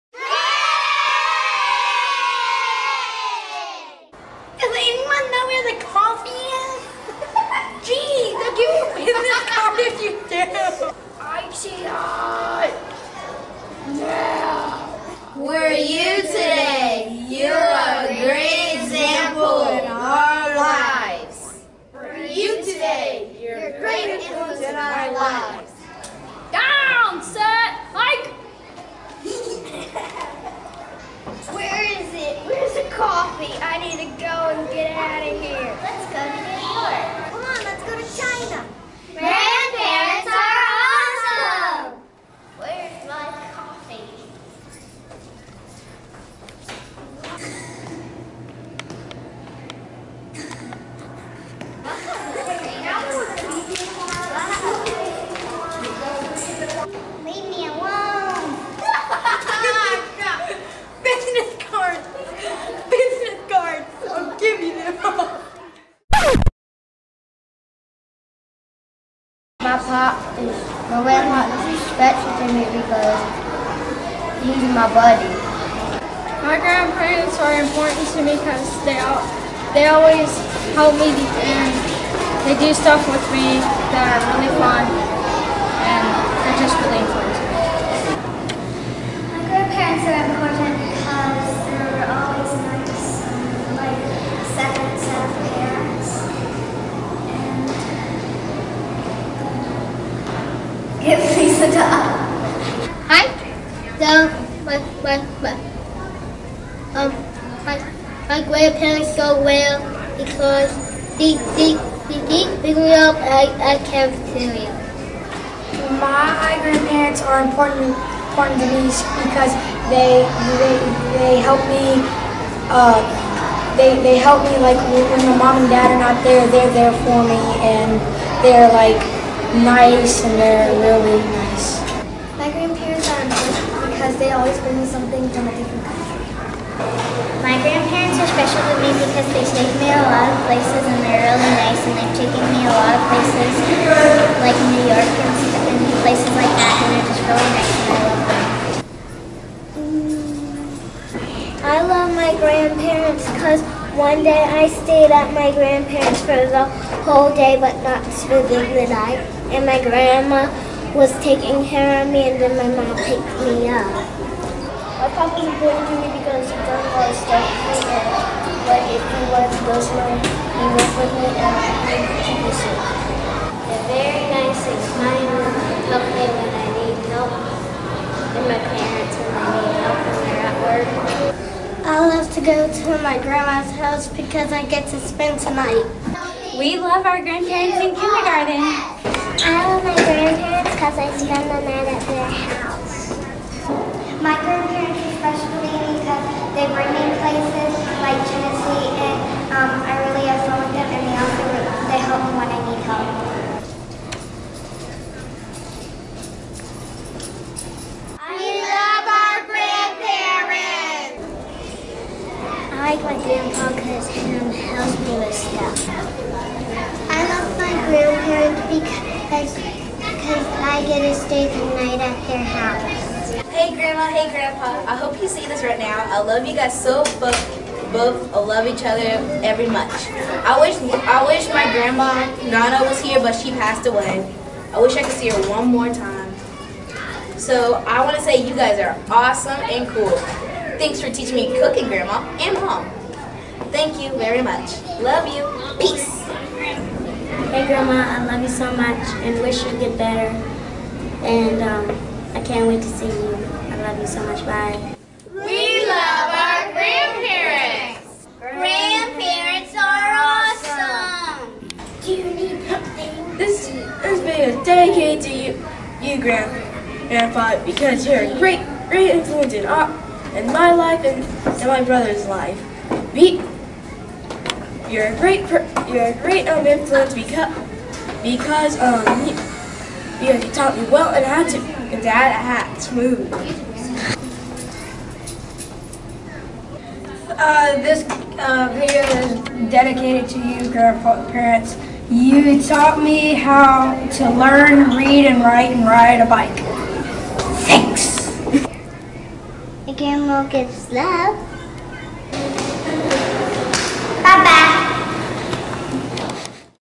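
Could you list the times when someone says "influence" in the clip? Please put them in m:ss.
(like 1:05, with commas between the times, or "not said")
4:29, 4:36.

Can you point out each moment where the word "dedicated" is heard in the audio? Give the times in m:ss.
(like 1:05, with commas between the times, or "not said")
4:24, 4:49.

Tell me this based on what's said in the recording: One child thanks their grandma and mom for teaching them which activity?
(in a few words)
Cooking.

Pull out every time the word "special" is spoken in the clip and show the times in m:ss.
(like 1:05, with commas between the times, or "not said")
1:11, 2:18, 3:15.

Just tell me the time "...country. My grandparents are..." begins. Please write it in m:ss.
2:15.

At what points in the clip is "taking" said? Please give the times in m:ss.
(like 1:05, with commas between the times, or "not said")
2:41.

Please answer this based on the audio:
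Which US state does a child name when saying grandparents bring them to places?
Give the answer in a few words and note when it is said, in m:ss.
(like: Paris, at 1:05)
Tennessee, at 3:18.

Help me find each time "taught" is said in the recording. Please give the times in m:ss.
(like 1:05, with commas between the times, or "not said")
4:40, 4:52.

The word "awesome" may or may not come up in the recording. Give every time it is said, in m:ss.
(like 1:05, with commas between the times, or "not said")
3:59, 4:20.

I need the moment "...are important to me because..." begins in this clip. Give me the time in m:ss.
1:17.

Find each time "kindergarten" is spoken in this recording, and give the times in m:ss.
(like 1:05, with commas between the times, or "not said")
3:07.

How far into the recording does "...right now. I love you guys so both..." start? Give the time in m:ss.
3:45.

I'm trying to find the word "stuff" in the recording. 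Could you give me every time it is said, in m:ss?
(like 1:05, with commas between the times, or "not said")
1:22, 2:25, 2:47, 3:35.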